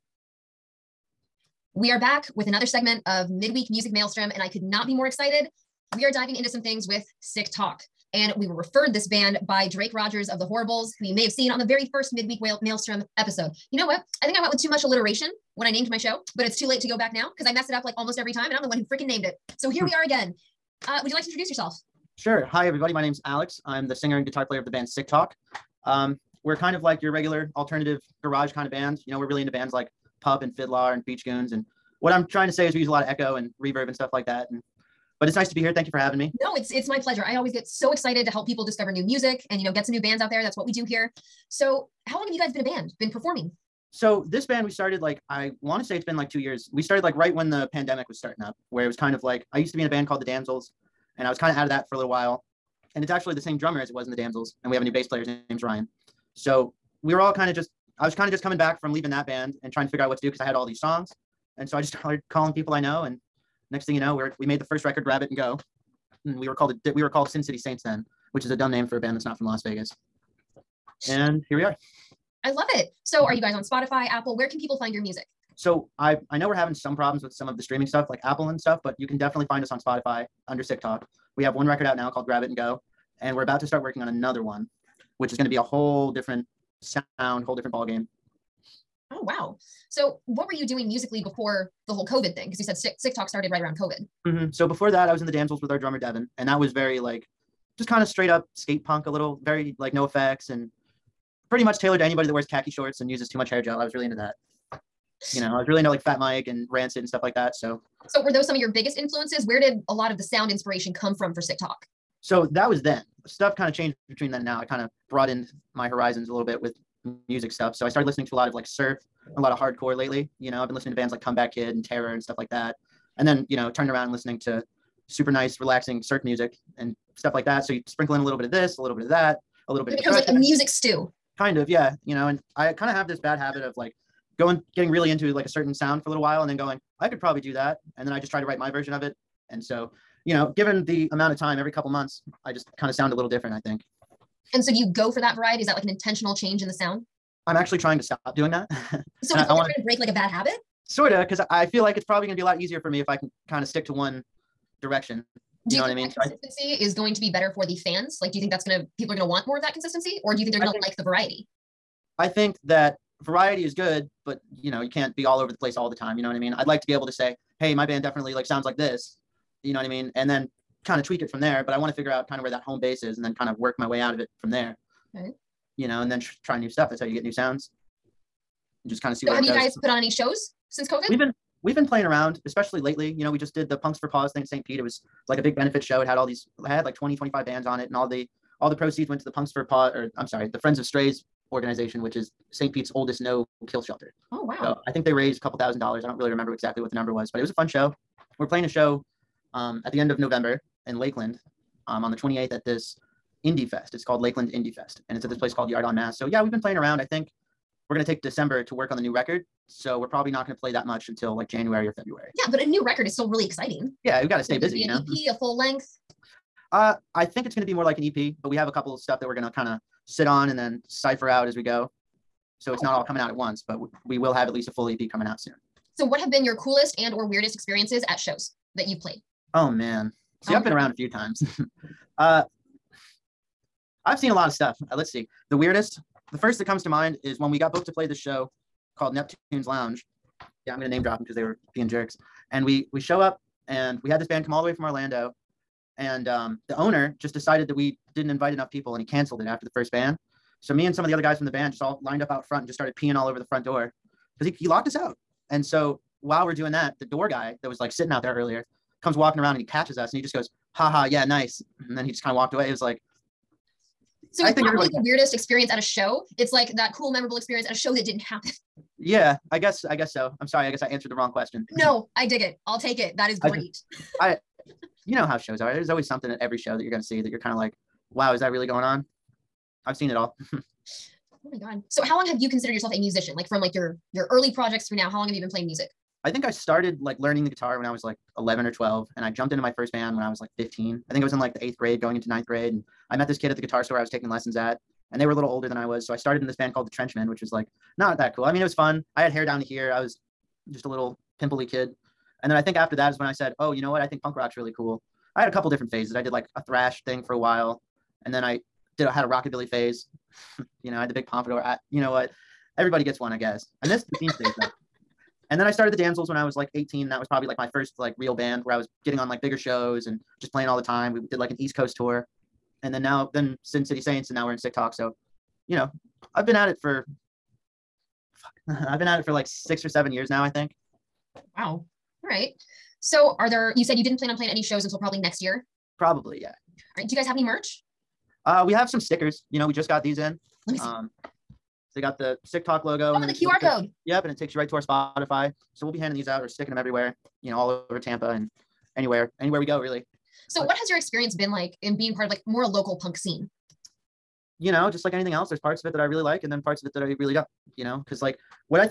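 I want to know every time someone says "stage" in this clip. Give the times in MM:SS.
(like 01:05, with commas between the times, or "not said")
05:14.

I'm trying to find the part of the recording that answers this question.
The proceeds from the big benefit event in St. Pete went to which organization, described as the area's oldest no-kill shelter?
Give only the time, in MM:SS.
03:10.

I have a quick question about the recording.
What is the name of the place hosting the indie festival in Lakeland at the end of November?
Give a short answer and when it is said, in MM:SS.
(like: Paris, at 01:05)
Yard on Mass, at 03:25.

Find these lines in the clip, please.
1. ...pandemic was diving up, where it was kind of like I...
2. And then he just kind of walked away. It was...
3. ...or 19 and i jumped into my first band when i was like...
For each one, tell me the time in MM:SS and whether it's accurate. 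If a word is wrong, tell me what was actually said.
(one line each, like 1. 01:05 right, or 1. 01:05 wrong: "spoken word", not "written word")
1. 00:47 wrong: "starting", not "diving"
2. 04:21 right
3. 04:48 wrong: "12", not "19".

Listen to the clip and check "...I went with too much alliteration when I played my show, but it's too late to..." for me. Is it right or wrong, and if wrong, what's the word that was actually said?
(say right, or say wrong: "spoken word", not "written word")
wrong: "named", not "played".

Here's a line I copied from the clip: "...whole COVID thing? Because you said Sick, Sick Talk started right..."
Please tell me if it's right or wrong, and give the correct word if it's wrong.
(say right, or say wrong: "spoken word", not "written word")
right.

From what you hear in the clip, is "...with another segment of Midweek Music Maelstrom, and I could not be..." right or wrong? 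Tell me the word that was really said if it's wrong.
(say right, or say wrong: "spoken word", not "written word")
right.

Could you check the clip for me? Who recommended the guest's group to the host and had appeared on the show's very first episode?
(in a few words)
Drake Rogers.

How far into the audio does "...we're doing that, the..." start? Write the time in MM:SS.
04:16.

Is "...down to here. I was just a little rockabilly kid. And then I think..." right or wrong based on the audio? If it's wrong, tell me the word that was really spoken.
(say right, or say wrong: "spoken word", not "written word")
wrong: "pimply", not "rockabilly".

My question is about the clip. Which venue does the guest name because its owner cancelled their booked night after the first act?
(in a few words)
Neptune's Lounge.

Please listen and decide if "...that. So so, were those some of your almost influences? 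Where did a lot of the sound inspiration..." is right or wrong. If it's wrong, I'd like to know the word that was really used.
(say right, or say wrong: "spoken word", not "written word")
wrong: "biggest", not "almost".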